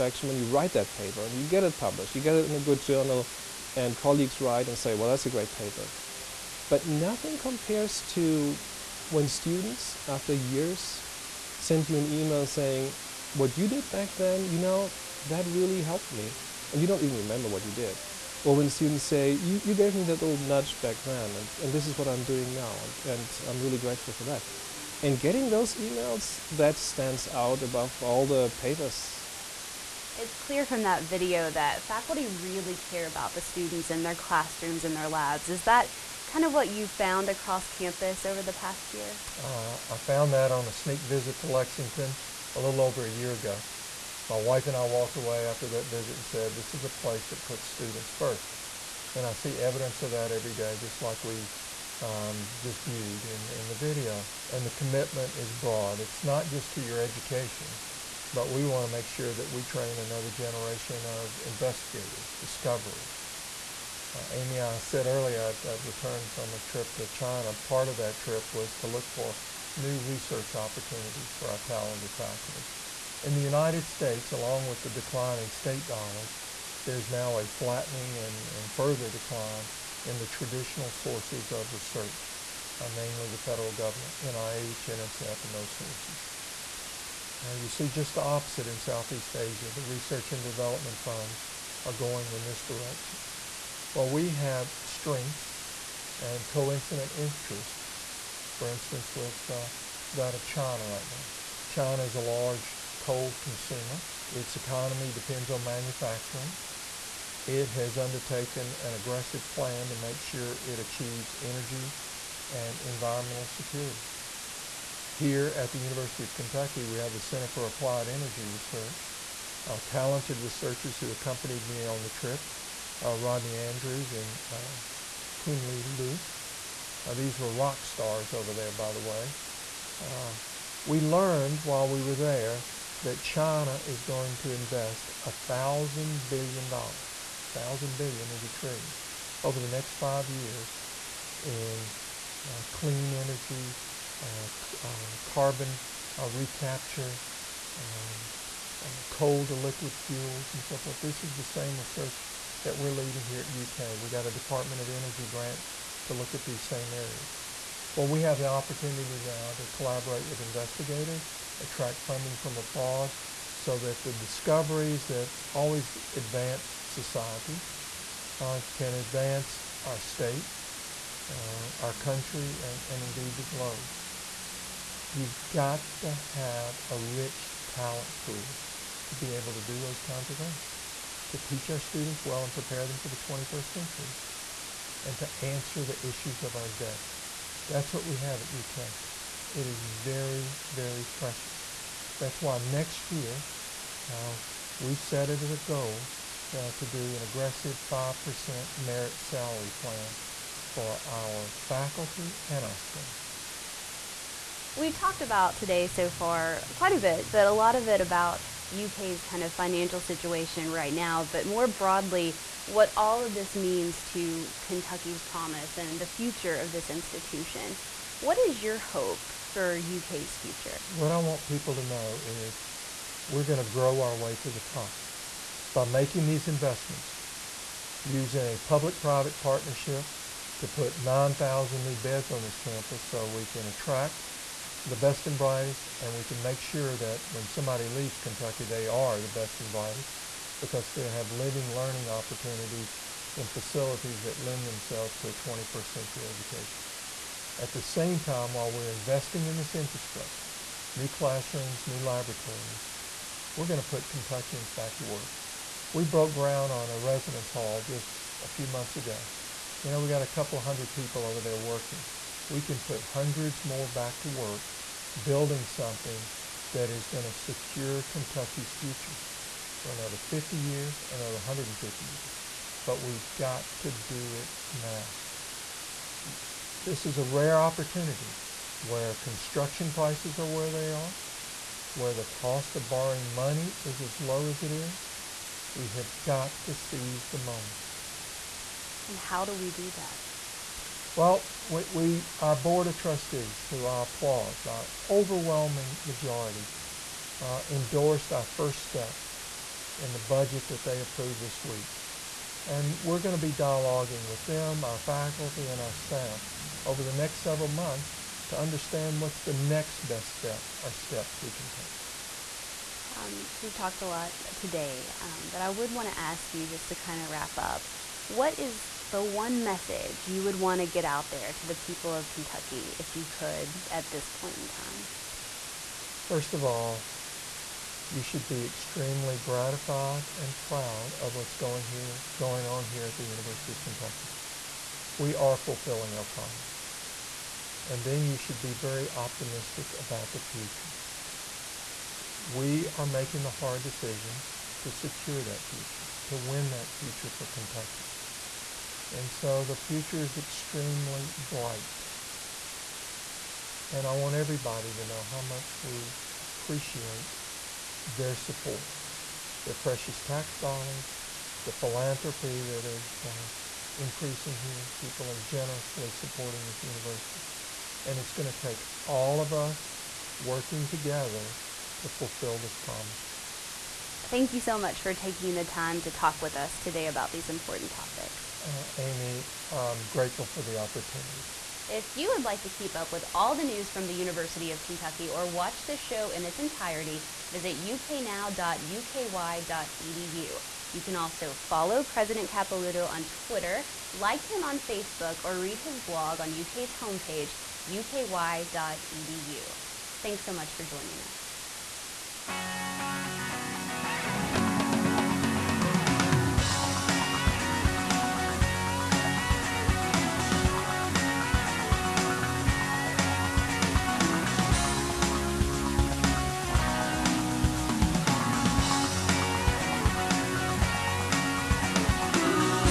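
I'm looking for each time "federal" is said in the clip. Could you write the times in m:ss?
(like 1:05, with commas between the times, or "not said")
1:23.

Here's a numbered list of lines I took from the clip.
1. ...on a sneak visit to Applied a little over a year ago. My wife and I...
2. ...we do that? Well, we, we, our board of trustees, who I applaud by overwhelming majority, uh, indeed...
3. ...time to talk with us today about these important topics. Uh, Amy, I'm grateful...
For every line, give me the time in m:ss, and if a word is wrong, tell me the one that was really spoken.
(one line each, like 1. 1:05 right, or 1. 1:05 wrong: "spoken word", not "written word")
1. 0:40 wrong: "Lexington", not "Applied"
2. 4:49 wrong: "endorsed", not "indeed"
3. 6:15 right.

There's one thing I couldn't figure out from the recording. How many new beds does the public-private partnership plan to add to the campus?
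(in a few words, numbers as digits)
9,000.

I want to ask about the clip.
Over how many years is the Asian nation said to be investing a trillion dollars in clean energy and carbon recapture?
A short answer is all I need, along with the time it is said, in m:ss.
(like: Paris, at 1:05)
5, at 2:19.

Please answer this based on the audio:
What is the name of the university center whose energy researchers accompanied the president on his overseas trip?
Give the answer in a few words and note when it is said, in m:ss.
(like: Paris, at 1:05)
Center for Applied Energy Research, at 1:57.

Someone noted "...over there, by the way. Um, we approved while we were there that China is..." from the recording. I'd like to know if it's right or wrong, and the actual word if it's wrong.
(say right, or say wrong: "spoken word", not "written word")
wrong: "learned", not "approved".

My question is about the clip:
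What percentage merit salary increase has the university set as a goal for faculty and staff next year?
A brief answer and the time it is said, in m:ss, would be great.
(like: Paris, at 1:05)
5%, at 3:17.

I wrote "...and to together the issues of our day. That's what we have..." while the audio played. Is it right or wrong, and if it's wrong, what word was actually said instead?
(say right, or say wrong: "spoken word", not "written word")
wrong: "answer", not "together".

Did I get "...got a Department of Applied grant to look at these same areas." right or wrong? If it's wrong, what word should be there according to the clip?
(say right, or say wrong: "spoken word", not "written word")
wrong: "Energy", not "Applied".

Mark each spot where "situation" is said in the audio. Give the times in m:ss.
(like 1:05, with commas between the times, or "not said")
3:29.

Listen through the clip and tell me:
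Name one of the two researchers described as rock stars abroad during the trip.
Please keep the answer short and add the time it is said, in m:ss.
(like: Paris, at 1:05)
Rodney Andrews, at 2:03.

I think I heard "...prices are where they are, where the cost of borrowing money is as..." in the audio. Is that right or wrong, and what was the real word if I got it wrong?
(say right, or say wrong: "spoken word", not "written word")
right.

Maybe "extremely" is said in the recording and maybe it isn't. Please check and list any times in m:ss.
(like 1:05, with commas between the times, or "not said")
5:28, 5:50.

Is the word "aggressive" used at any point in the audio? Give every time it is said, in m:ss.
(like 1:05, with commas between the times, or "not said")
1:48, 3:17.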